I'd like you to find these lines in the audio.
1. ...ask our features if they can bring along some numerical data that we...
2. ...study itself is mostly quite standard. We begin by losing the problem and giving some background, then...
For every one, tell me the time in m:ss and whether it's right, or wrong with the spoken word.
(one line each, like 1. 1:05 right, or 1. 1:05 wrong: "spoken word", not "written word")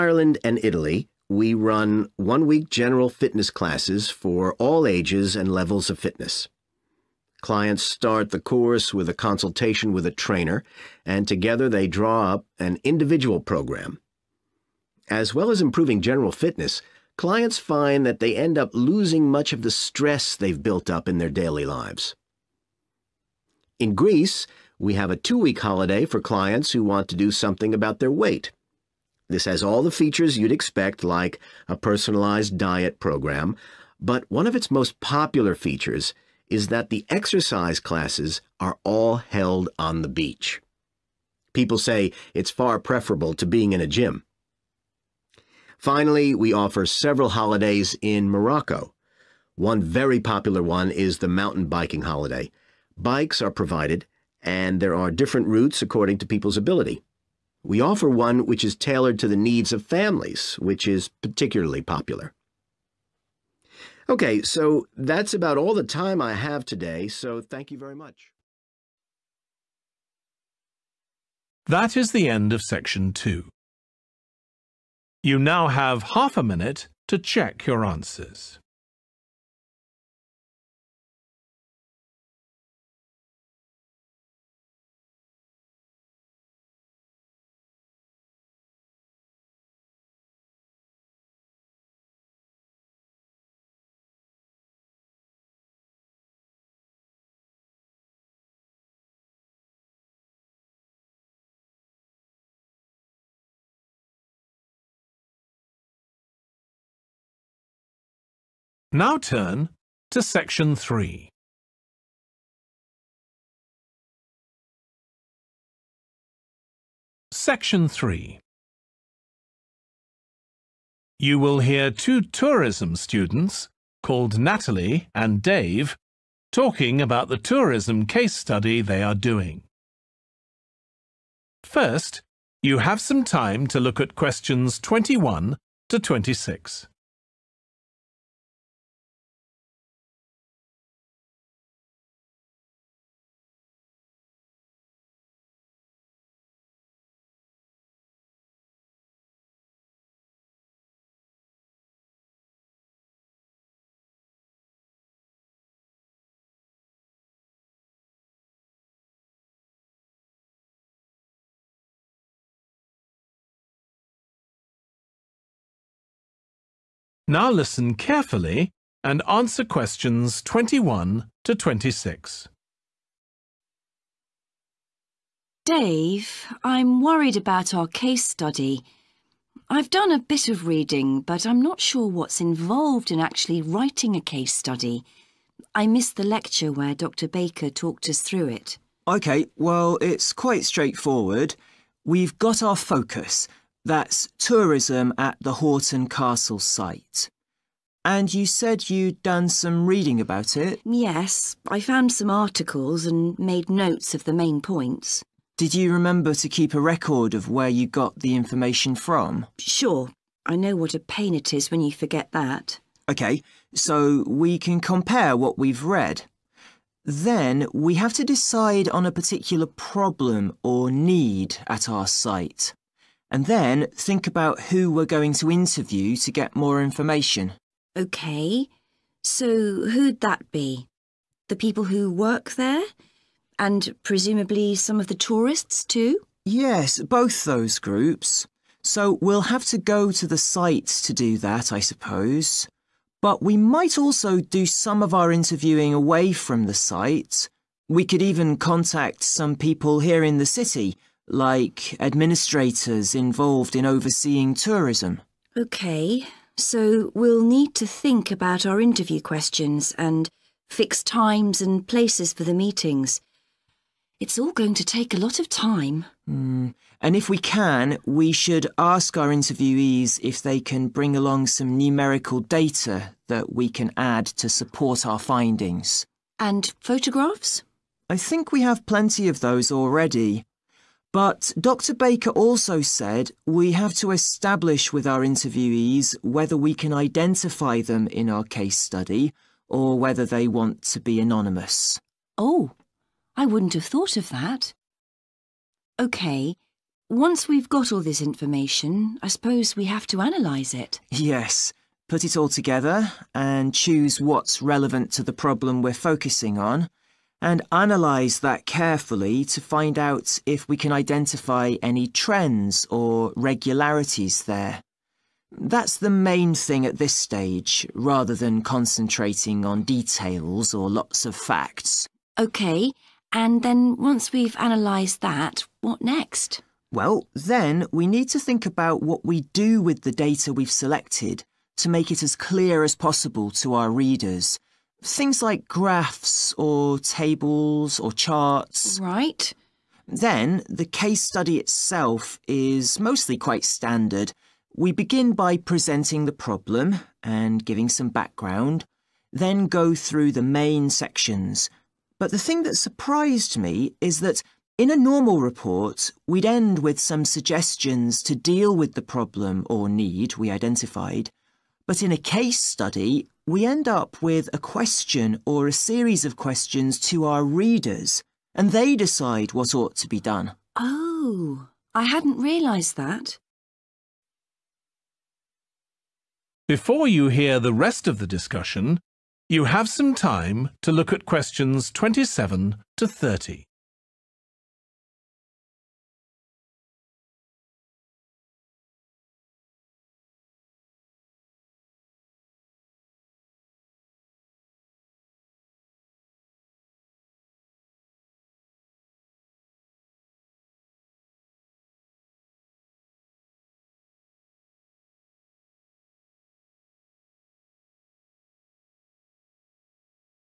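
1. 4:28 wrong: "interviewees", not "features"
2. 5:41 wrong: "presenting", not "losing".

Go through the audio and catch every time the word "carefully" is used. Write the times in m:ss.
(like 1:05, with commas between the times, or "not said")
2:47, 5:08.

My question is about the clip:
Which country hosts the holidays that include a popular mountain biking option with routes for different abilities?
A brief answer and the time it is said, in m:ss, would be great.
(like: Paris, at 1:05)
Morocco, at 0:48.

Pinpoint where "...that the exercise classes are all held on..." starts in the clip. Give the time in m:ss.
0:36.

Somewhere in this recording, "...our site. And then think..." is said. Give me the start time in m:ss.
3:41.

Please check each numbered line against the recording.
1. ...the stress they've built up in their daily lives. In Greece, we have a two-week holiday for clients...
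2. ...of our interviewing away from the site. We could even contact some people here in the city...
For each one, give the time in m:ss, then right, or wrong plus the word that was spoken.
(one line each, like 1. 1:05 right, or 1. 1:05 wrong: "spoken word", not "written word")
1. 0:19 right
2. 4:05 right.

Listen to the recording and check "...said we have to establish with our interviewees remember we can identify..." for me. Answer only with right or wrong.
wrong.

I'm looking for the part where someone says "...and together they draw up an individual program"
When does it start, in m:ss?
0:11.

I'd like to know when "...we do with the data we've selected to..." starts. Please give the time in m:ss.
5:29.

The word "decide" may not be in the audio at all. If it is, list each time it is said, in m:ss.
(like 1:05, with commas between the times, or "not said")
3:38, 6:08.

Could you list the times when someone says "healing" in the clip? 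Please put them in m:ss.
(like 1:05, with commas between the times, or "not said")
not said.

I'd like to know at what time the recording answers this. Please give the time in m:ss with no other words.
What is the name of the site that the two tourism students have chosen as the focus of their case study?
3:15.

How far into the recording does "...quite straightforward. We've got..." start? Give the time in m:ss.
3:10.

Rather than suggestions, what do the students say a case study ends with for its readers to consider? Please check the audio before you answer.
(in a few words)
a question.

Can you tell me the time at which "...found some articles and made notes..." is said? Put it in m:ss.
3:21.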